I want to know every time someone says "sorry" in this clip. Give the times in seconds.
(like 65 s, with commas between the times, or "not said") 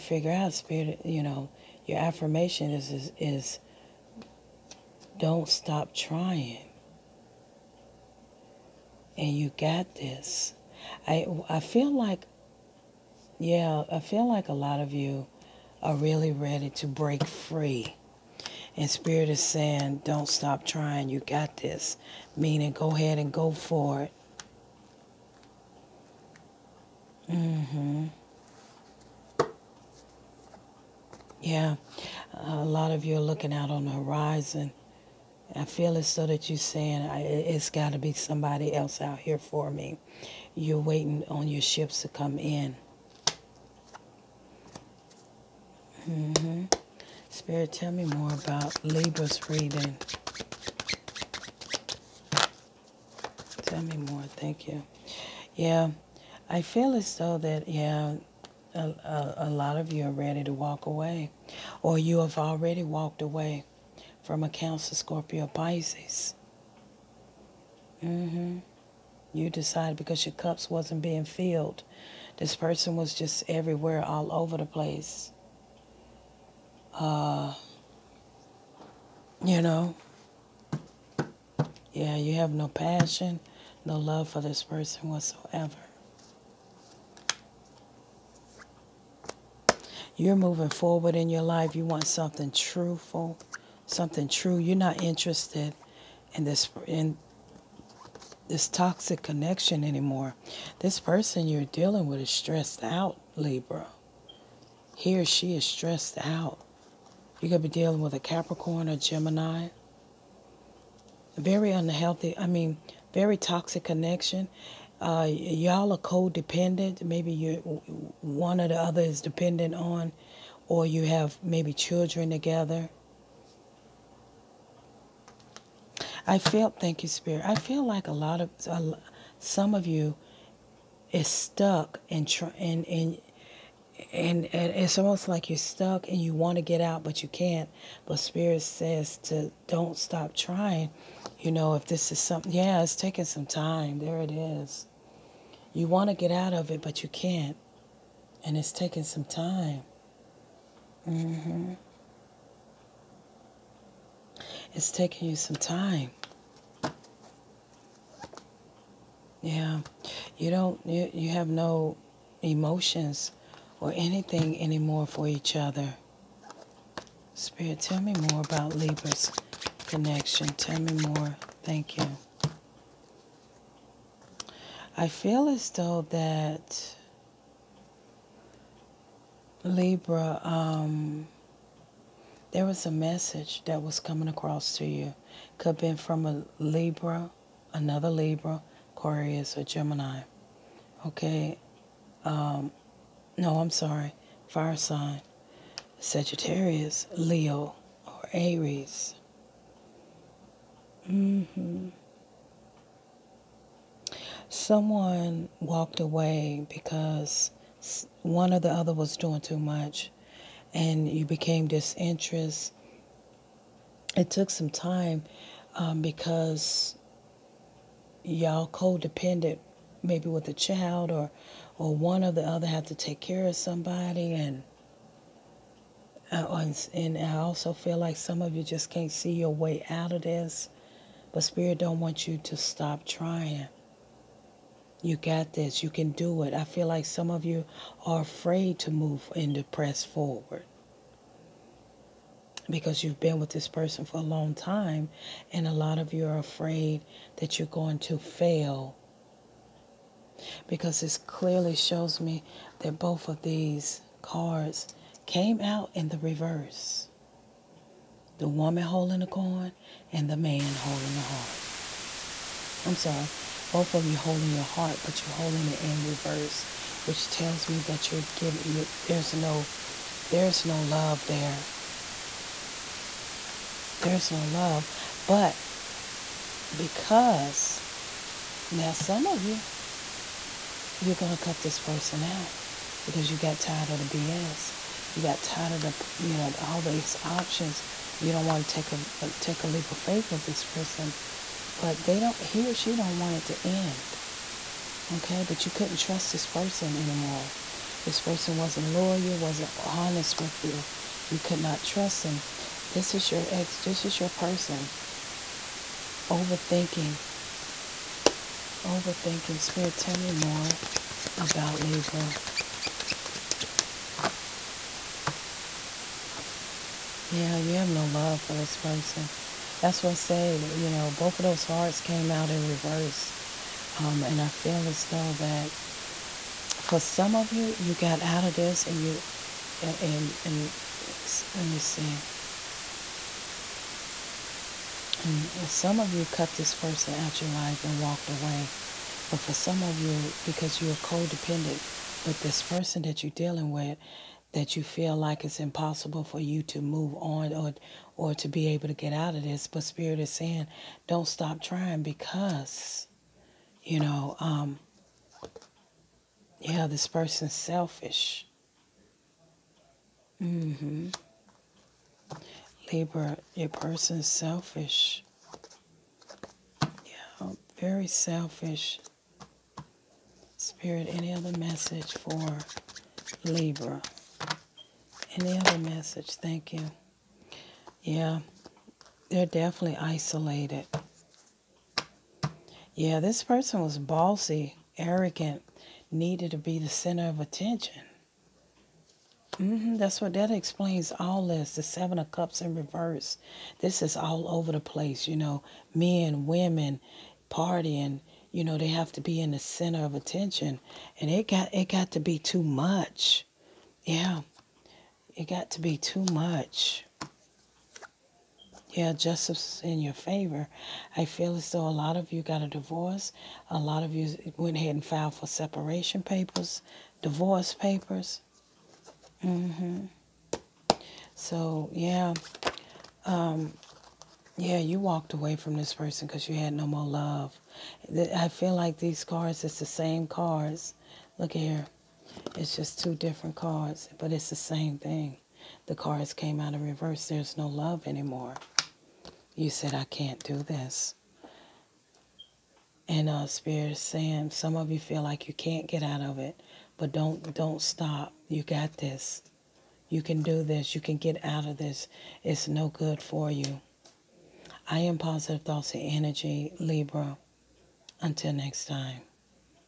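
193 s, 262 s.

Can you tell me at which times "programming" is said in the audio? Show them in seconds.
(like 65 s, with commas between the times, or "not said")
not said.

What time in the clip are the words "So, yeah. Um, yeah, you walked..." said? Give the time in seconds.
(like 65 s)
421 s.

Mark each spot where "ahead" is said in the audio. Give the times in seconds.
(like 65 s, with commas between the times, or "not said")
22 s, 414 s.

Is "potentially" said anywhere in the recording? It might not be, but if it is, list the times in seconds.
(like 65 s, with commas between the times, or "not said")
not said.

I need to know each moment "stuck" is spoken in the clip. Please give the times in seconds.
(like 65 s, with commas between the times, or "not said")
131 s, 135 s.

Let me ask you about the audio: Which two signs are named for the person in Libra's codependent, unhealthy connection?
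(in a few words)
Capricorn or Gemini.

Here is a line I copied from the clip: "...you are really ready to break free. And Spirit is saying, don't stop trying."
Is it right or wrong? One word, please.
right.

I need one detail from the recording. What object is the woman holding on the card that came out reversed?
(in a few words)
The coin.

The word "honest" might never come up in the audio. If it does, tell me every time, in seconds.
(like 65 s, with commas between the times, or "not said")
299 s.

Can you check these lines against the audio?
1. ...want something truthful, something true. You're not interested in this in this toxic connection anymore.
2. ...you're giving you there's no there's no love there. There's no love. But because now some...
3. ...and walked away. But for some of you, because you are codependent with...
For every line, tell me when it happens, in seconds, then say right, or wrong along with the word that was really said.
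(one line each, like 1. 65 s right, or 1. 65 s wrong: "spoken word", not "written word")
1. 91 s right
2. 268 s right
3. 337 s right.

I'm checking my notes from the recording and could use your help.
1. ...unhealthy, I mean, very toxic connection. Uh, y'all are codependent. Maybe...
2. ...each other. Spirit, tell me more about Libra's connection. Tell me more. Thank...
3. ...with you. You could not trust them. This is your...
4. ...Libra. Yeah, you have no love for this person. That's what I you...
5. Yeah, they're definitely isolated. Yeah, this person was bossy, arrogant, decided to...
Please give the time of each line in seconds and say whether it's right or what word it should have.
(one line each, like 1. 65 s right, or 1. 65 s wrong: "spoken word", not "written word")
1. 111 s right
2. 165 s right
3. 300 s right
4. 311 s right
5. 378 s wrong: "needed", not "decided".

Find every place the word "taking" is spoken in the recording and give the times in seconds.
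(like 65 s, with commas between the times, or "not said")
142 s, 148 s, 154 s.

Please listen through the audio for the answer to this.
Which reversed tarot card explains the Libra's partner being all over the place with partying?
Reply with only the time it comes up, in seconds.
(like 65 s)
391 s.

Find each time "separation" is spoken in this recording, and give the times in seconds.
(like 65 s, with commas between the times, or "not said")
415 s.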